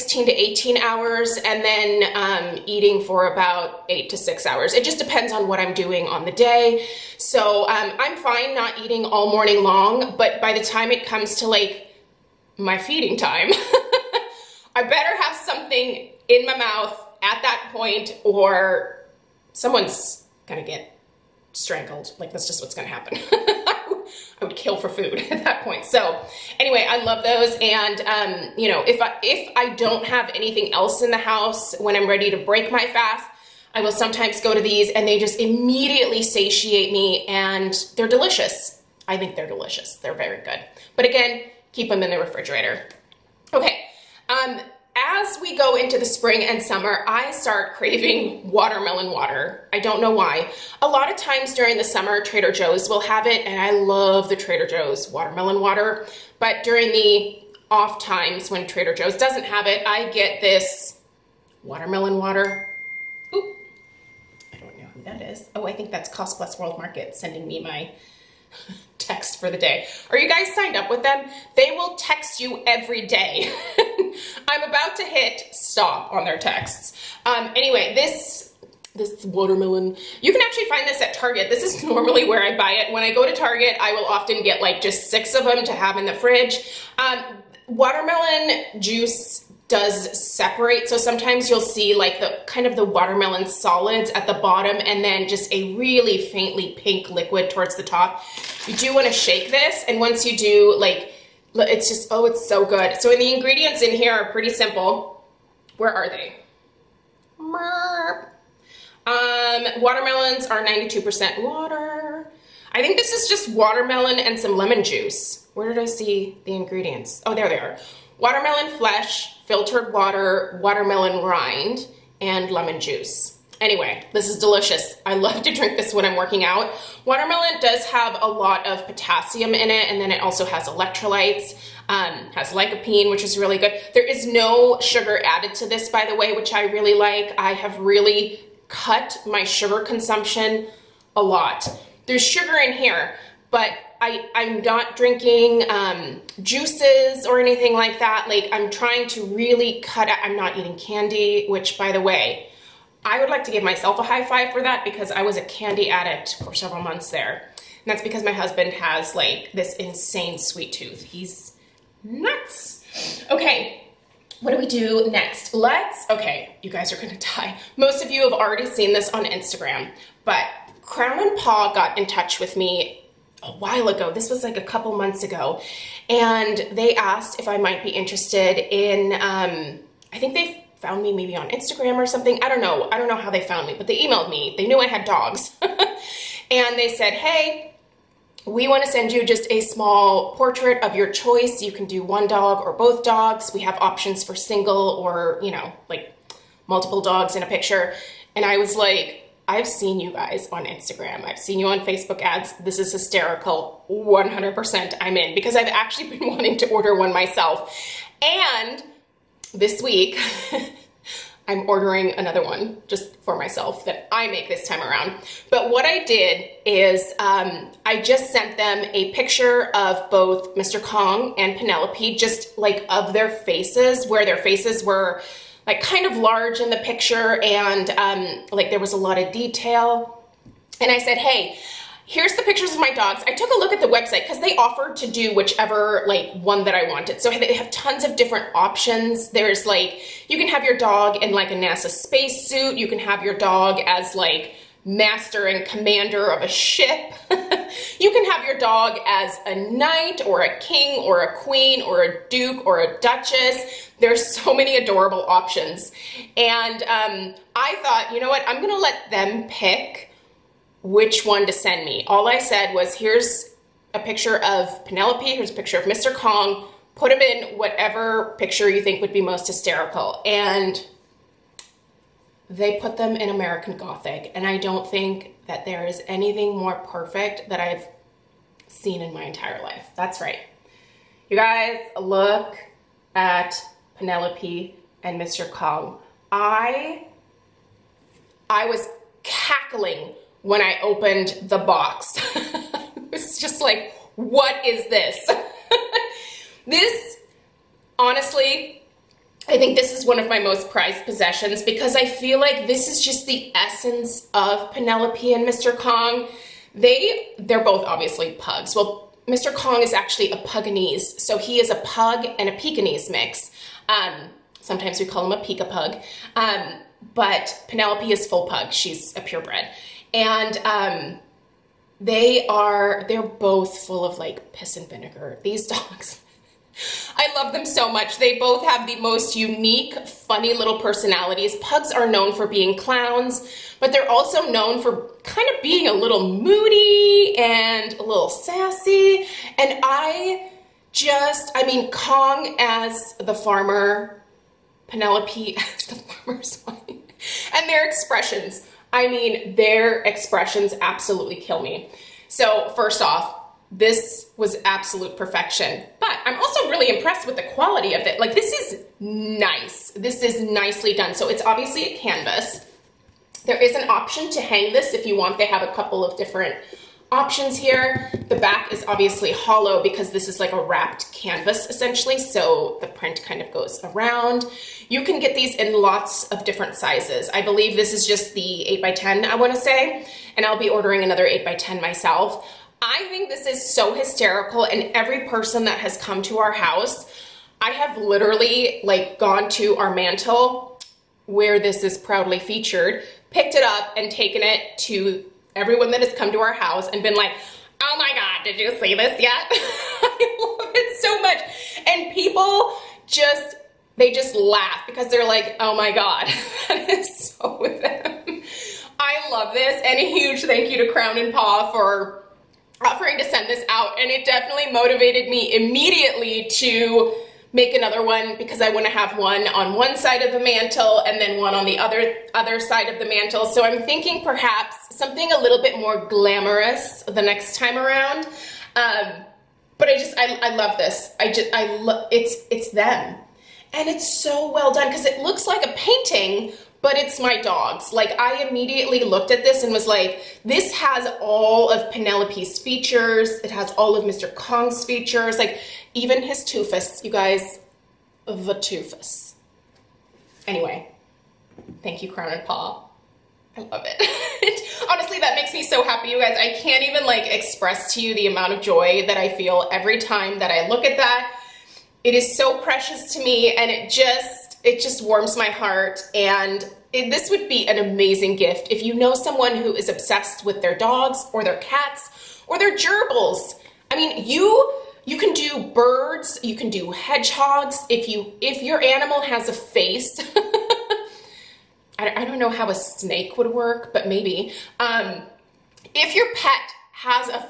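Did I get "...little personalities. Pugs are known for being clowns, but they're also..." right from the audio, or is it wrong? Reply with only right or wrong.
right.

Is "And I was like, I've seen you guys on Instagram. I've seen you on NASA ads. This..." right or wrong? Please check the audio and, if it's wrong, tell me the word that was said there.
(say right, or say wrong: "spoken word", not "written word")
wrong: "Facebook", not "NASA".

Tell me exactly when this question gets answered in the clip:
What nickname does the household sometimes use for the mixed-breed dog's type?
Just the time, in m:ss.
5:15.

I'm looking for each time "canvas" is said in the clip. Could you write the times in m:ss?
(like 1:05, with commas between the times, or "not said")
6:01, 6:11.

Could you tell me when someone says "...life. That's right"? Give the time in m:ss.
4:39.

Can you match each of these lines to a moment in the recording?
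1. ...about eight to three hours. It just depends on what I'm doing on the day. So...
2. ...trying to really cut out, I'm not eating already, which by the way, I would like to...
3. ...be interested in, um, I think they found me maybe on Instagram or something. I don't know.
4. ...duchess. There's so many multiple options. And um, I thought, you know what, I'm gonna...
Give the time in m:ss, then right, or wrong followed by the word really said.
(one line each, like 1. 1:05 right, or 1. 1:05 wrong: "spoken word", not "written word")
1. 0:03 wrong: "six", not "three"
2. 2:28 wrong: "candy", not "already"
3. 2:57 right
4. 4:12 wrong: "adorable", not "multiple".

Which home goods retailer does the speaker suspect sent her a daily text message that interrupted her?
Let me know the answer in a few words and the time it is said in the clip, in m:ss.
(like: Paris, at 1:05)
Cost Plus World Market, at 1:06.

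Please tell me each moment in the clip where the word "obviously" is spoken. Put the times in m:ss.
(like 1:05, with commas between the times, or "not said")
5:07, 6:01, 6:08.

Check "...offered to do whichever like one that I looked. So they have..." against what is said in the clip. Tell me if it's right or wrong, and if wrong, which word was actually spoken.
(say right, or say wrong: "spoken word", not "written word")
wrong: "wanted", not "looked".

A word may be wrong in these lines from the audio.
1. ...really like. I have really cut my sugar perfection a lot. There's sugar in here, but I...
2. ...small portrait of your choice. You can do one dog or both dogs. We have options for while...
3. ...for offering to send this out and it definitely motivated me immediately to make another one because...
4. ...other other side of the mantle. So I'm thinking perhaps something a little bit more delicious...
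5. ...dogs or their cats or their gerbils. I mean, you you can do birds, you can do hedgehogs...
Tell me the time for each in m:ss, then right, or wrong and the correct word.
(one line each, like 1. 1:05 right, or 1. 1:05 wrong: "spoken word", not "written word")
1. 2:16 wrong: "consumption", not "perfection"
2. 3:09 wrong: "single", not "while"
3. 6:51 right
4. 7:01 wrong: "glamorous", not "delicious"
5. 7:50 right.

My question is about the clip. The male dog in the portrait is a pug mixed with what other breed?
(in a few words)
Pekingese.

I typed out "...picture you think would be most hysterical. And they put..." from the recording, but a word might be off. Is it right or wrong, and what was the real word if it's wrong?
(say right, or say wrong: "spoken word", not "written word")
right.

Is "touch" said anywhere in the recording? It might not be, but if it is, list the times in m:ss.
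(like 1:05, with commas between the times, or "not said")
2:52.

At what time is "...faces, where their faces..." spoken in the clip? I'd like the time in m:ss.
3:43.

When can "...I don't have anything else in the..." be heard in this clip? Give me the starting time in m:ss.
0:29.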